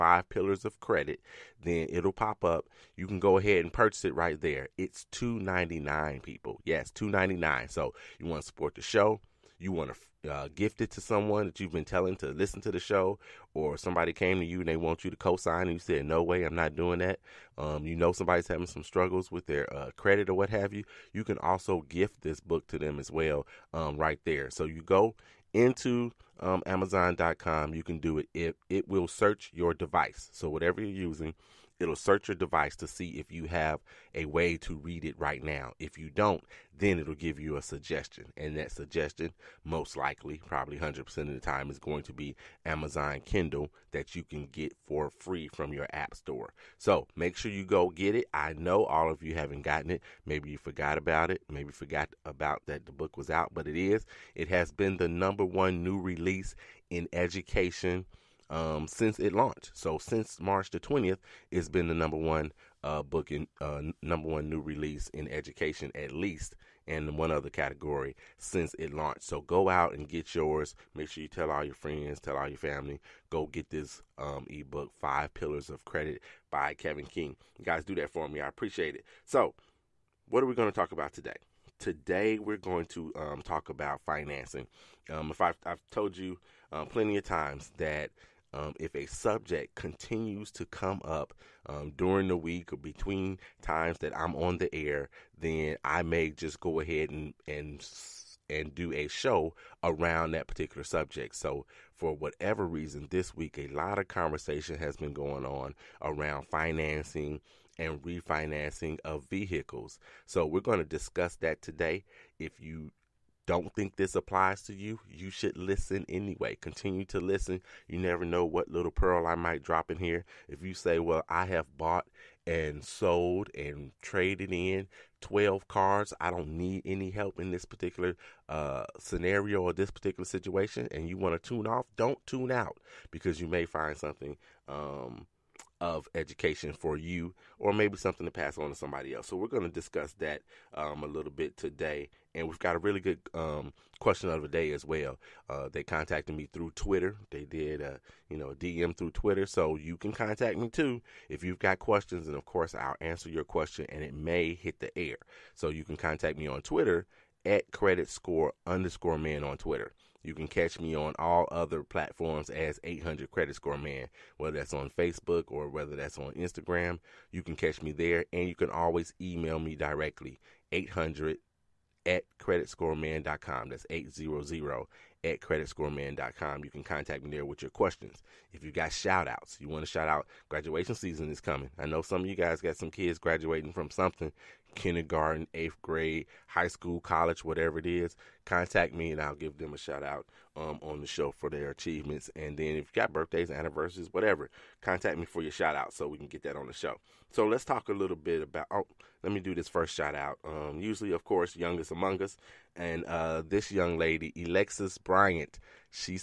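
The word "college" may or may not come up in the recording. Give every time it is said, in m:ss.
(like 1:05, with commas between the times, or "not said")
3:06.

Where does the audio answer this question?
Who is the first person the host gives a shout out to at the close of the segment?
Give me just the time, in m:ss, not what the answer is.
3:24.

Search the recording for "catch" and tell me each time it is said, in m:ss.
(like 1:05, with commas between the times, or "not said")
2:40, 2:47.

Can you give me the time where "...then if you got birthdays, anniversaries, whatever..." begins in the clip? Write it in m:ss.
3:12.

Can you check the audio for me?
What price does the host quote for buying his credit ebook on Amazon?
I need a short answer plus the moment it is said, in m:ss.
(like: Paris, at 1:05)
$2.99, at 0:04.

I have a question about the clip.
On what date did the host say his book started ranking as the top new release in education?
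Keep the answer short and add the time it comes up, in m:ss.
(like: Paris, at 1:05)
March 20, at 1:00.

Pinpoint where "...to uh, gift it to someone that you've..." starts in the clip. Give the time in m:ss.
0:09.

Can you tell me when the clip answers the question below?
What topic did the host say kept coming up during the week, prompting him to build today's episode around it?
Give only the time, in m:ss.
1:46.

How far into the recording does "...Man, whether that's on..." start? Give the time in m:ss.
2:43.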